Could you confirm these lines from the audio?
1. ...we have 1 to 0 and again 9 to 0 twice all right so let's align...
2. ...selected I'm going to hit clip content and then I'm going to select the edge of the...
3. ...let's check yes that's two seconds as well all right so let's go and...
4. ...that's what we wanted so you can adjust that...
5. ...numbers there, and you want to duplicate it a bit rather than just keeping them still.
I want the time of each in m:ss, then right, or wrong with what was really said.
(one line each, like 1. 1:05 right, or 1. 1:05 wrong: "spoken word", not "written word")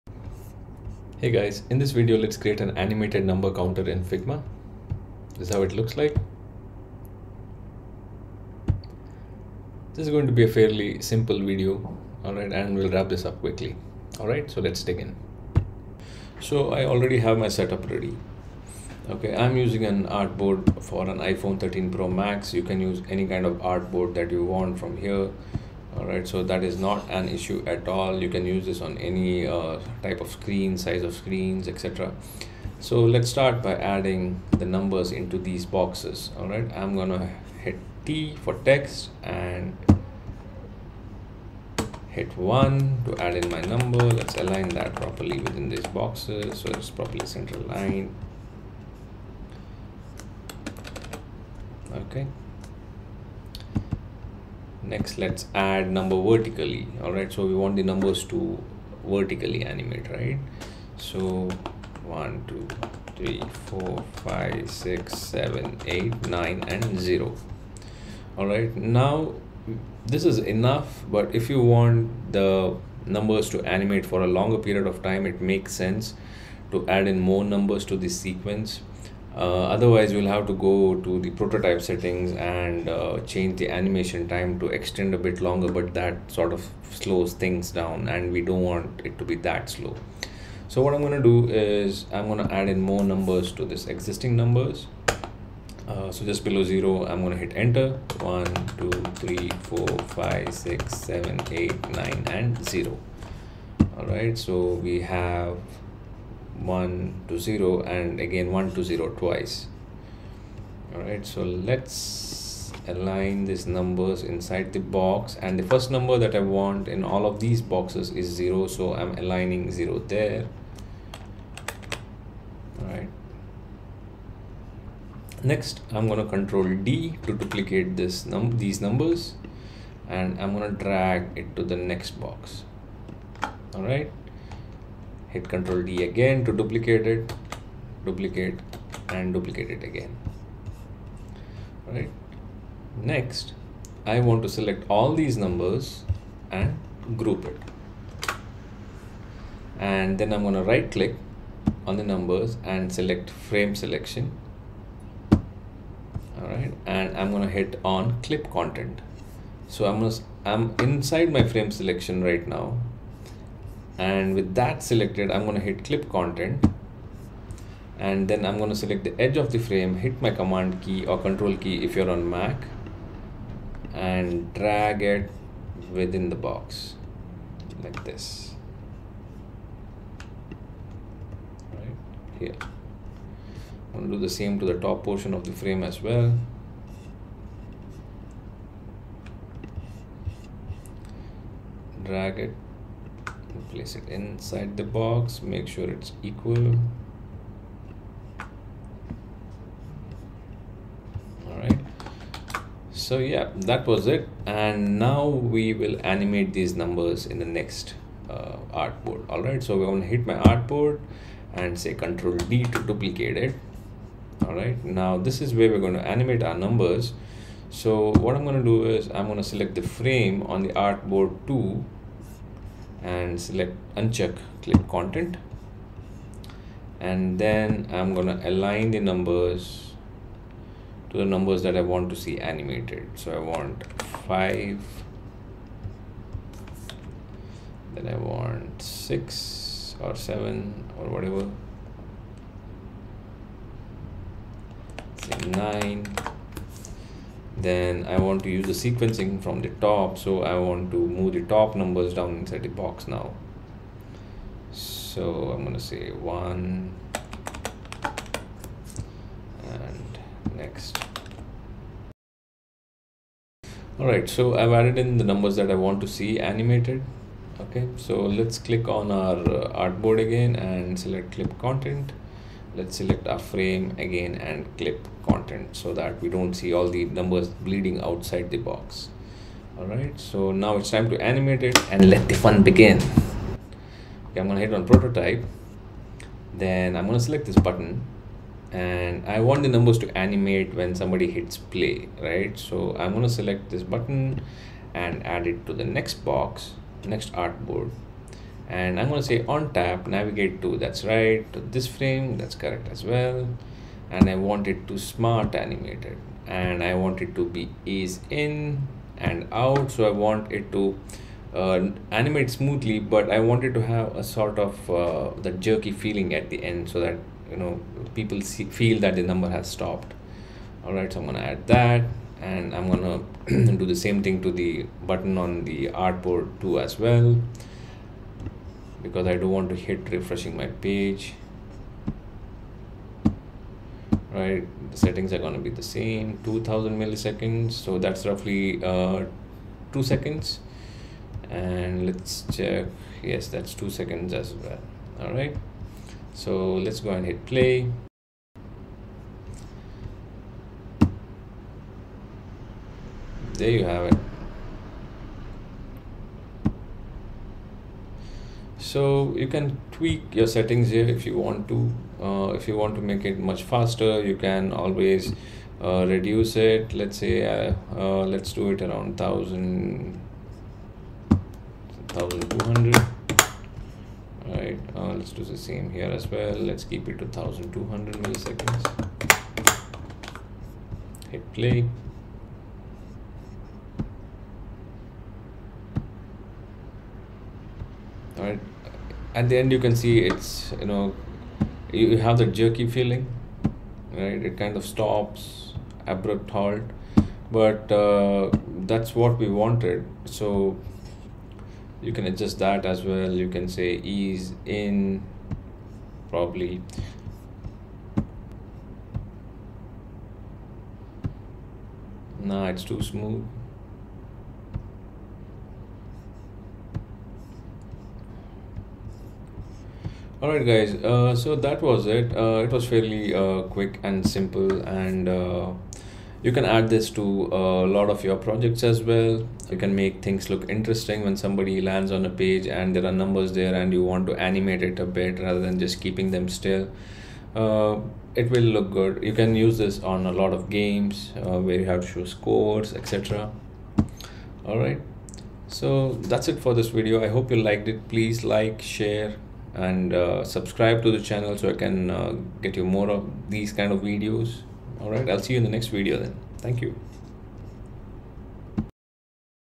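1. 1:44 wrong: "1", not "9"
2. 2:44 right
3. 5:42 right
4. 6:38 right
5. 7:13 wrong: "animate", not "duplicate".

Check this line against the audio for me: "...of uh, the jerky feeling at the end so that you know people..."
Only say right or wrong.
right.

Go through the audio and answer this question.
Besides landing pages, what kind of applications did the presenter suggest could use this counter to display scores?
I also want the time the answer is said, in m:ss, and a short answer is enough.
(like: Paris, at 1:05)
games, at 7:20.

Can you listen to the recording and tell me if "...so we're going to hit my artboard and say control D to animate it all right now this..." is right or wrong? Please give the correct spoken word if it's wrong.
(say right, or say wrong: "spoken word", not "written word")
wrong: "duplicate", not "animate".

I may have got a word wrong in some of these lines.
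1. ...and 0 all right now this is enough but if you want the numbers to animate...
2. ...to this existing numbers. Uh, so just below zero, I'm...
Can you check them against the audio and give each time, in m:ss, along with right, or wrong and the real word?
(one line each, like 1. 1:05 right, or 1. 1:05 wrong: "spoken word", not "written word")
1. 1:06 right
2. 1:33 right.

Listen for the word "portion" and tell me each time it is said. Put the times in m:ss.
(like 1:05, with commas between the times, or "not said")
3:05.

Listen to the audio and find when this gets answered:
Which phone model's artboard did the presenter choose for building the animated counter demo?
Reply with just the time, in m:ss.
0:21.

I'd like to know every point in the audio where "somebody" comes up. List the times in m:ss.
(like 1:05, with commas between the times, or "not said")
4:50, 7:11.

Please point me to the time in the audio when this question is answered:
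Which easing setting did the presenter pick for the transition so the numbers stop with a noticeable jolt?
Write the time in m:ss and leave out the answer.
5:07.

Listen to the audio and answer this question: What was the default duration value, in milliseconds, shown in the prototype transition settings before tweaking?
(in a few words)
2000.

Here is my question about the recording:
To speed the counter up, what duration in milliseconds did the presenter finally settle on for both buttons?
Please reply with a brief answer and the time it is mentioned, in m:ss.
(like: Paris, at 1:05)
1200, at 6:17.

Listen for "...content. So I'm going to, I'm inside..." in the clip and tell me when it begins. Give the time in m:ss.
2:38.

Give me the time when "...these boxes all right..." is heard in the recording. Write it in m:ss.
0:35.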